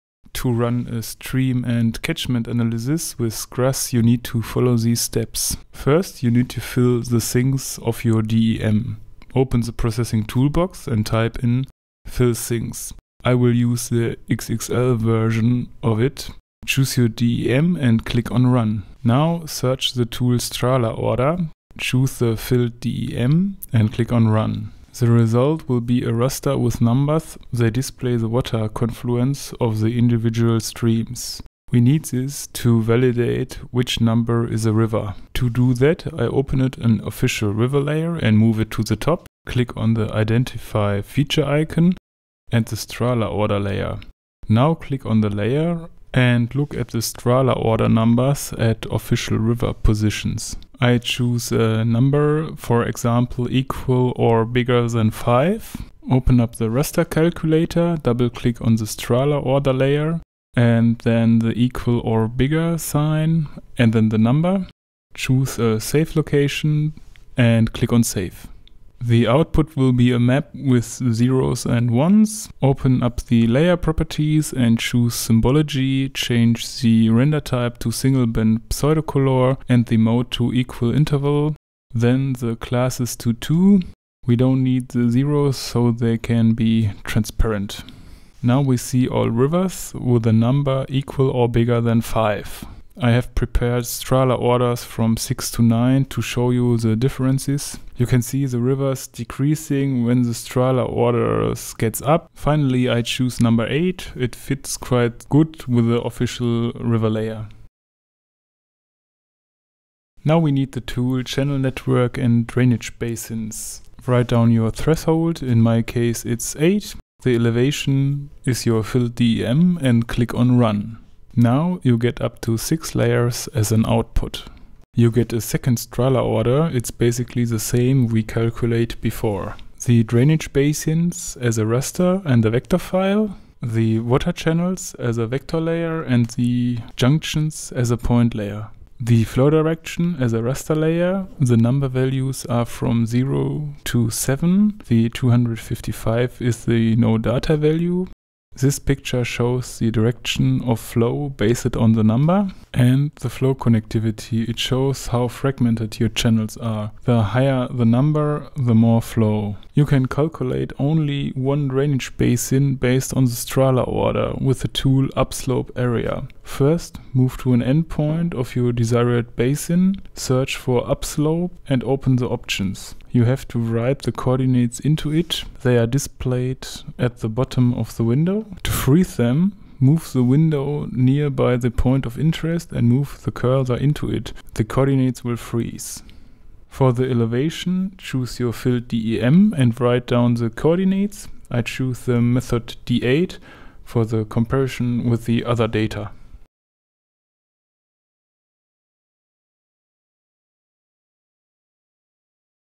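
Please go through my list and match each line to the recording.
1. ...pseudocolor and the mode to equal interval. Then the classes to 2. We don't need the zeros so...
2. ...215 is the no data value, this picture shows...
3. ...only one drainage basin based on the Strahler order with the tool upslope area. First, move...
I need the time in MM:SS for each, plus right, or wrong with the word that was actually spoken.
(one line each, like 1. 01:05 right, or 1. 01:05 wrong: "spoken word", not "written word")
1. 01:18 right
2. 02:25 wrong: "255", not "215"
3. 02:40 right.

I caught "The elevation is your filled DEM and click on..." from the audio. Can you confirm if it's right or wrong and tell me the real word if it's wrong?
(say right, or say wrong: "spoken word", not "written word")
right.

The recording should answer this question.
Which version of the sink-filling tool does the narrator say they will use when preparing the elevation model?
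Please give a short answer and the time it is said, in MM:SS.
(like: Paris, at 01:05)
XXL, at 00:14.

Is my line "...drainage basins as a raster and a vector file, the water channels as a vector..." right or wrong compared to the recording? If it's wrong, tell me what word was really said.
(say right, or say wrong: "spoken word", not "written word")
right.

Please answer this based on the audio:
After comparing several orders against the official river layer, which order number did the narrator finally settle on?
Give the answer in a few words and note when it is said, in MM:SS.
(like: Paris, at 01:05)
8, at 01:43.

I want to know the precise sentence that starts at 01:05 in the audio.
Choose a save location and click on save.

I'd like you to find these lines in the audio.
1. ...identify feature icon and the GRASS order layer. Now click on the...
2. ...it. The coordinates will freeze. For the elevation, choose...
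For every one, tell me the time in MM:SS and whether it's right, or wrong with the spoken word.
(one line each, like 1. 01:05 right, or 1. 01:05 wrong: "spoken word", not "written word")
1. 00:40 wrong: "Strahler", not "GRASS"
2. 03:04 right.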